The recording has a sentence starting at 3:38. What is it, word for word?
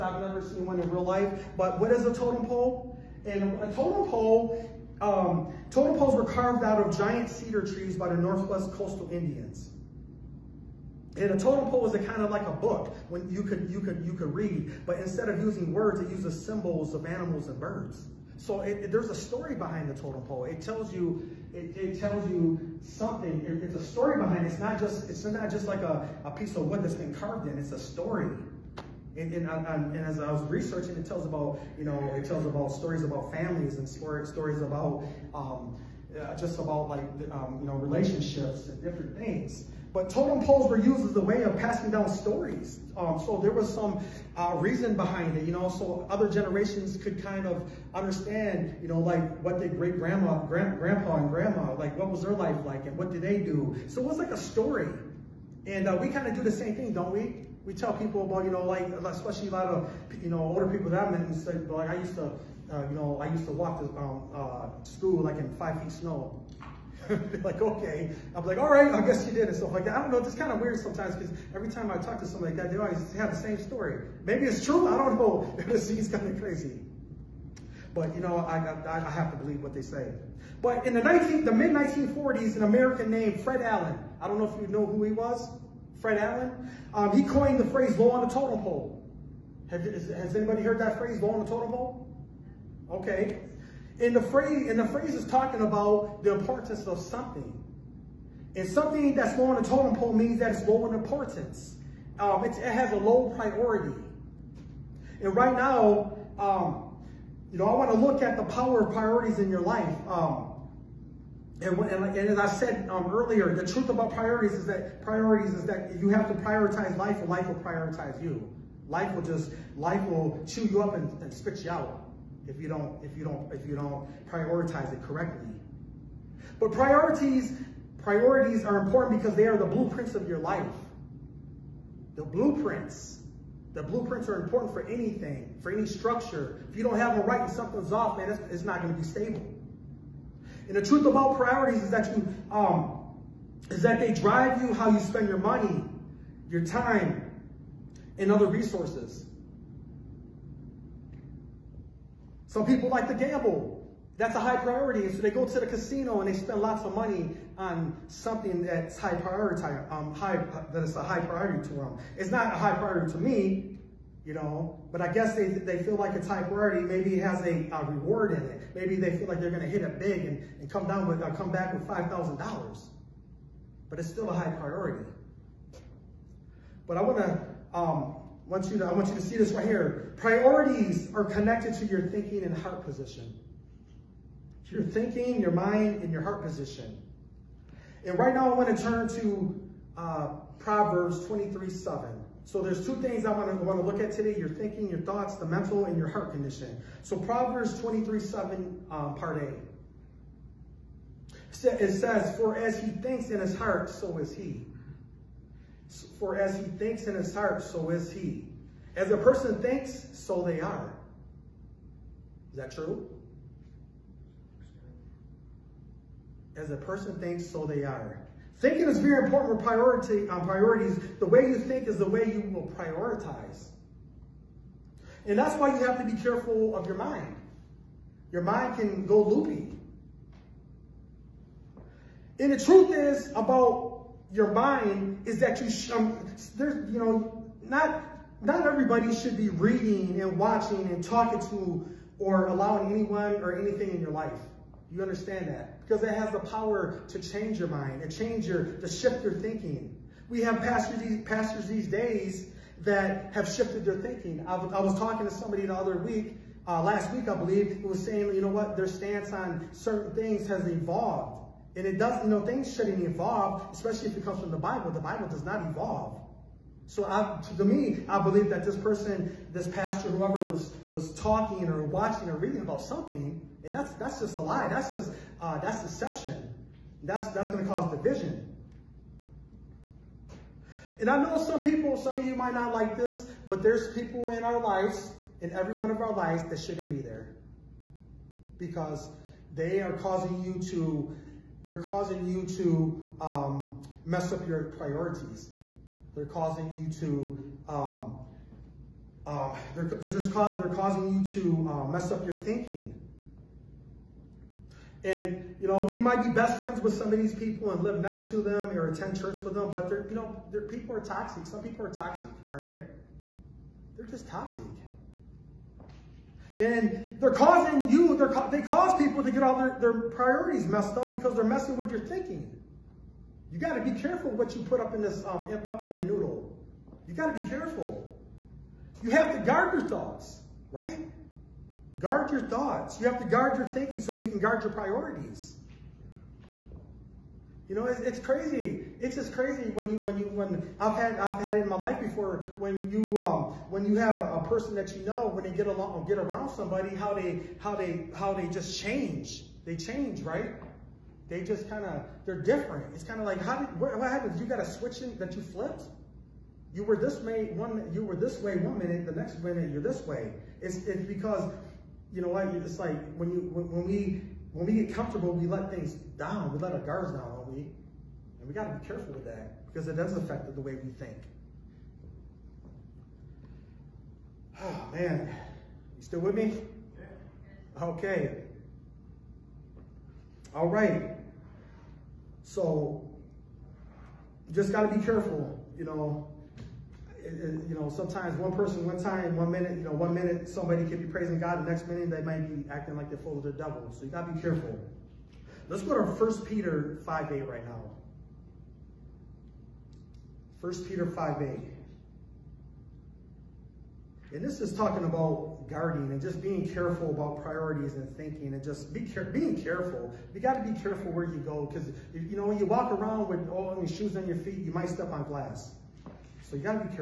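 Thinking is very important for priority on um, priorities.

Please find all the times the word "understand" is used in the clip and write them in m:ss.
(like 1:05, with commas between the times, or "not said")
0:47, 4:05.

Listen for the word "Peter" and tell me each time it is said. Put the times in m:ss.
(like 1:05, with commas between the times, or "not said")
6:36, 6:40.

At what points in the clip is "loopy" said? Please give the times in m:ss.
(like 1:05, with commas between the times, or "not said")
3:49.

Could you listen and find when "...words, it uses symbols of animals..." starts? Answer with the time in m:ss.
0:15.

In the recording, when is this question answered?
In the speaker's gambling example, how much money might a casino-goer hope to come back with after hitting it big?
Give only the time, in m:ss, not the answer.
2:51.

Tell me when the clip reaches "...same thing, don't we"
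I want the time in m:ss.
0:56.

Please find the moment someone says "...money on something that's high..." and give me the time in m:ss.
2:36.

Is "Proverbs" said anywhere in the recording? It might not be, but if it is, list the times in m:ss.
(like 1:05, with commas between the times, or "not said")
3:10, 3:17.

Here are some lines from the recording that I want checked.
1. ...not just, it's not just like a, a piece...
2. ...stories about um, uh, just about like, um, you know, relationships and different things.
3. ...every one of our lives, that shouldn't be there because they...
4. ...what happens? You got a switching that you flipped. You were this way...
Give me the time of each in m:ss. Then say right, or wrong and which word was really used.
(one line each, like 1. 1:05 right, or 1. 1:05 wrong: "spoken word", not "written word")
1. 0:24 right
2. 0:33 right
3. 4:45 right
4. 5:53 right.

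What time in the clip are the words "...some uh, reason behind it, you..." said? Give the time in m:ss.
0:43.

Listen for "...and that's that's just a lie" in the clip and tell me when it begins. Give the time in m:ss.
4:33.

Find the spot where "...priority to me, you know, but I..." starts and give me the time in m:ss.
2:42.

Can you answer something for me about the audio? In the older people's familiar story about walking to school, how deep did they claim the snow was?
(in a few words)
5 feet.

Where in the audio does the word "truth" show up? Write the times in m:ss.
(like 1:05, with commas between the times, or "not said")
1:53, 2:20, 3:52.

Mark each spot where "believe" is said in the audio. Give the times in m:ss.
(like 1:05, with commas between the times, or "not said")
1:19, 4:17, 4:28.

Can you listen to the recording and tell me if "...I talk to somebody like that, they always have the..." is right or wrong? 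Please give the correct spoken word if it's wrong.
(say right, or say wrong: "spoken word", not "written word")
right.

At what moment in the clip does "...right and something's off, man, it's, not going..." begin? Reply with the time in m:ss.
2:17.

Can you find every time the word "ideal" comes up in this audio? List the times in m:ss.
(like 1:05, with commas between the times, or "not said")
not said.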